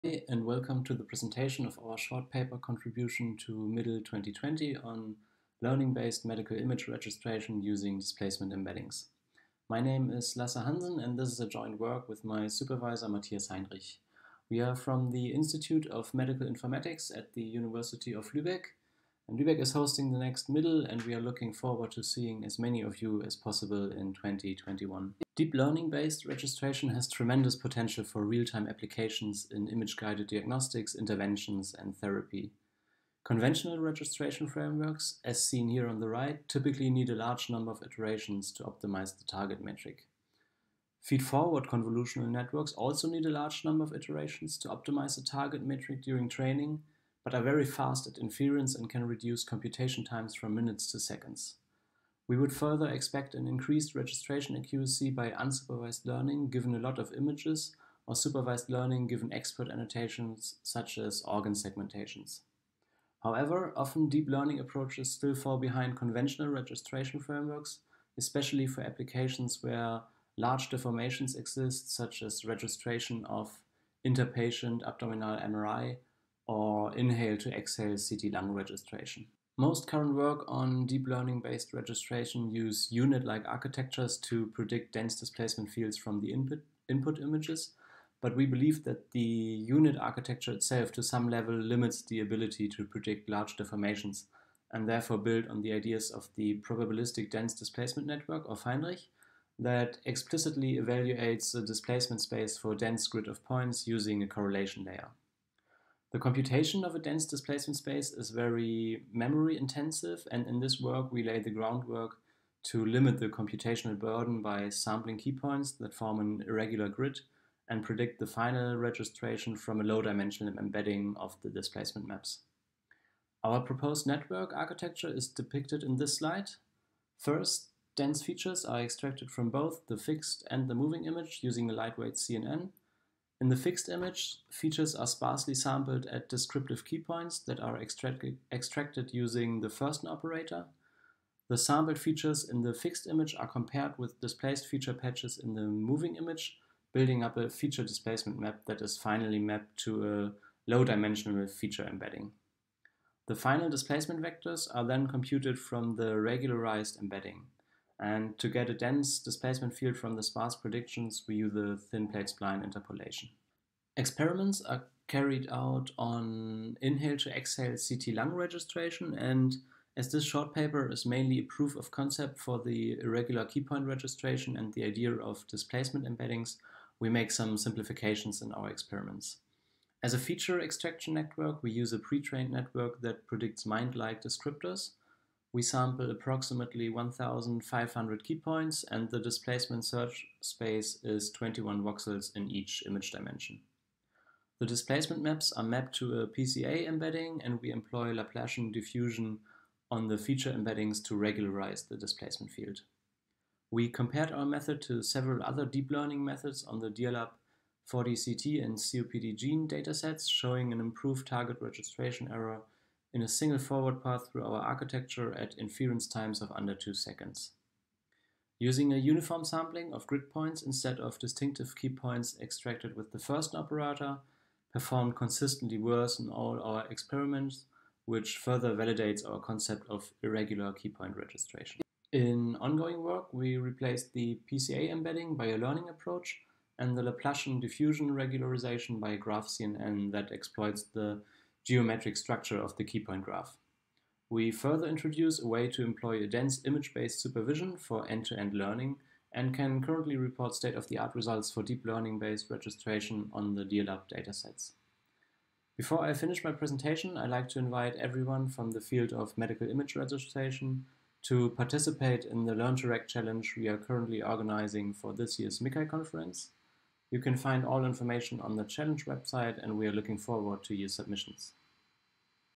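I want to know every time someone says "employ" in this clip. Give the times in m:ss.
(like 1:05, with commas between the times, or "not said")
3:17, 4:05.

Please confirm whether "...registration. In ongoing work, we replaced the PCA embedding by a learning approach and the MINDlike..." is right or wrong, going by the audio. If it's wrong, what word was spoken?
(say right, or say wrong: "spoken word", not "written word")
wrong: "Laplacian", not "MINDlike".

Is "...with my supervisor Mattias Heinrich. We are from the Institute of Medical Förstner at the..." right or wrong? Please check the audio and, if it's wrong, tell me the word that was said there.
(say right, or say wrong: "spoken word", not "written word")
wrong: "Informatics", not "Förstner".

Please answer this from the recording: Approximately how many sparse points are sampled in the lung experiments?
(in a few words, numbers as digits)
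1500.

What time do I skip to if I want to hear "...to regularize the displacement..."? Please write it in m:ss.
3:21.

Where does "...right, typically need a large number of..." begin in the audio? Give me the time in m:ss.
0:36.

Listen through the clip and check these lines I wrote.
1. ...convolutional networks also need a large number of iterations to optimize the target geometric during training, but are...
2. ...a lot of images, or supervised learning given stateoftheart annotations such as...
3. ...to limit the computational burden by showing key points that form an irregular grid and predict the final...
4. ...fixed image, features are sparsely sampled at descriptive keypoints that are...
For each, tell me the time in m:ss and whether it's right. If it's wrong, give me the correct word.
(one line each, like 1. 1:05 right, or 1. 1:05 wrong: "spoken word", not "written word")
1. 0:41 wrong: "metric", not "geometric"
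2. 0:56 wrong: "expert", not "stateoftheart"
3. 1:52 wrong: "sampling", not "showing"
4. 2:13 right.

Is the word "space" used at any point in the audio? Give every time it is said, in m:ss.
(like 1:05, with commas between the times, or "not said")
1:42, 1:47, 3:10.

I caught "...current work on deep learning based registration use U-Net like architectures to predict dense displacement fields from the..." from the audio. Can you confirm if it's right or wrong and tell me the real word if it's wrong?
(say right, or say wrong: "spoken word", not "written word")
right.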